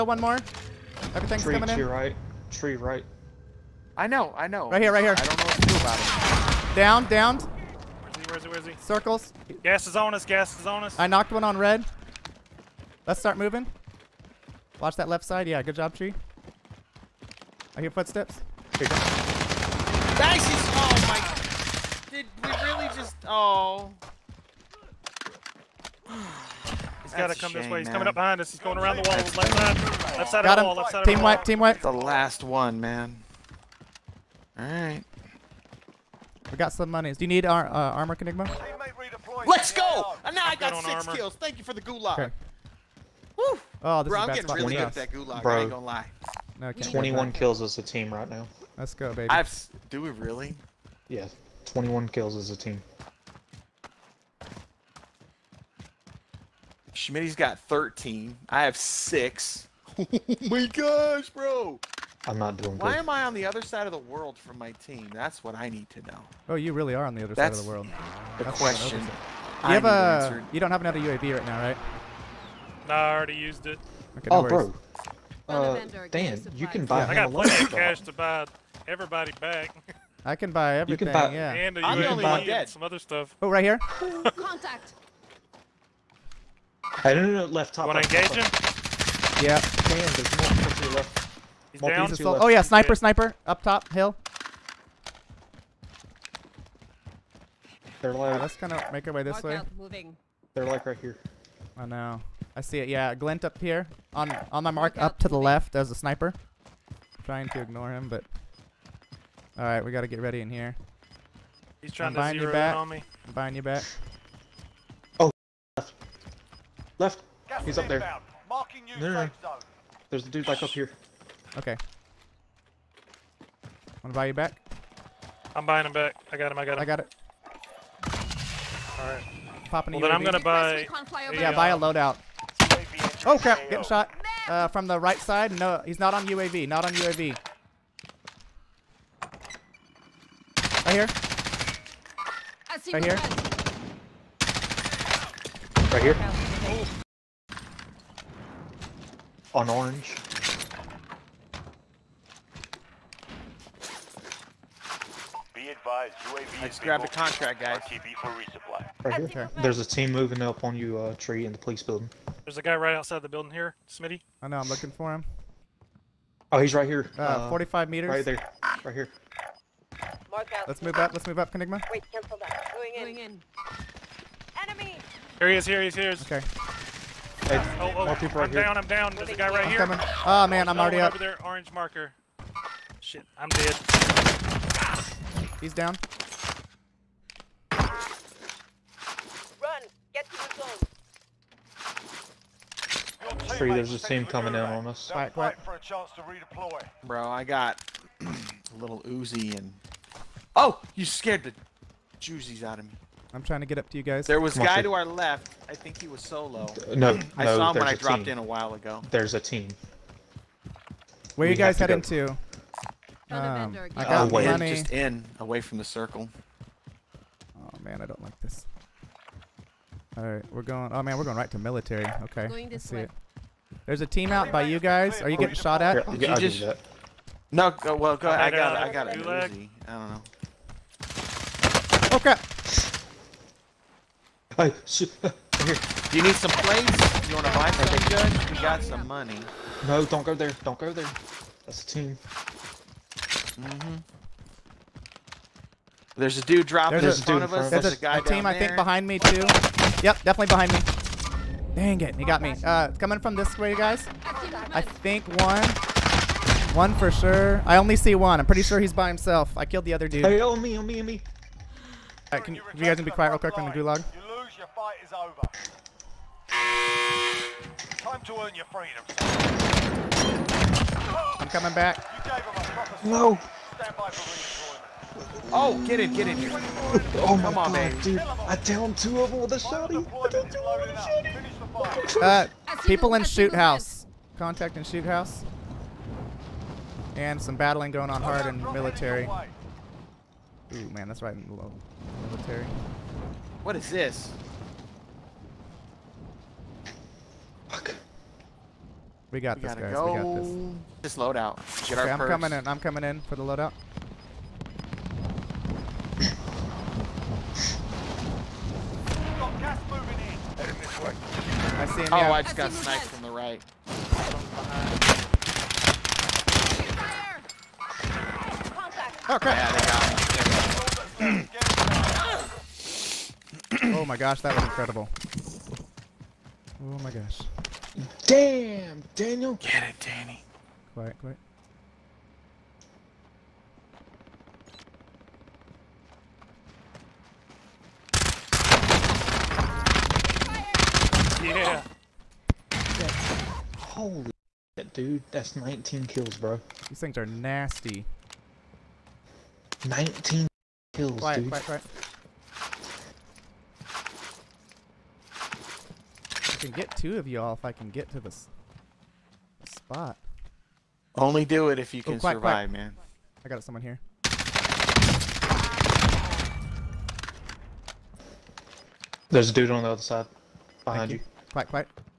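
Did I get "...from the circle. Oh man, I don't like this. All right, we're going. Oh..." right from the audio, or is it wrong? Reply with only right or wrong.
right.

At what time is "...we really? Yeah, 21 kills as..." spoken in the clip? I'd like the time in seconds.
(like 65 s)
50 s.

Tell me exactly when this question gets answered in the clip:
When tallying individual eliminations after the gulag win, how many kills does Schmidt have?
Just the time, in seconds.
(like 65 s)
56 s.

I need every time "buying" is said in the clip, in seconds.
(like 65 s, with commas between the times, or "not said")
113 s, 125 s.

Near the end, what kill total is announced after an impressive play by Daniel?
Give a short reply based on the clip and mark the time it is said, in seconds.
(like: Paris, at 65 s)
19, at 345 s.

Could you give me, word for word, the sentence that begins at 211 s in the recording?
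Where we you guys heading to?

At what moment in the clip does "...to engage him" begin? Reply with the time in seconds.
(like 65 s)
88 s.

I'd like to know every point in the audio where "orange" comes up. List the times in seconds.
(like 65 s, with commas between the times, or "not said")
149 s, 181 s.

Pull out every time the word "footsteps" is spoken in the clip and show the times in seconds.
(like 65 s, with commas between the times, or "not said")
17 s.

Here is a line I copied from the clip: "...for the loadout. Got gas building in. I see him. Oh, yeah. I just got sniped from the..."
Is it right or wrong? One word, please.
wrong.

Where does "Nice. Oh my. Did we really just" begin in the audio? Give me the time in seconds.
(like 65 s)
18 s.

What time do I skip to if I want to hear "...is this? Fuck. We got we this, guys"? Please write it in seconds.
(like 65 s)
293 s.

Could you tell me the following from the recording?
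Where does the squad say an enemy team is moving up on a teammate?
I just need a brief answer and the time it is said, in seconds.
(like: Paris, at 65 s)
the police building, at 161 s.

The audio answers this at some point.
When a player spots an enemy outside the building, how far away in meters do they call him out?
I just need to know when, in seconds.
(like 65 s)
167 s.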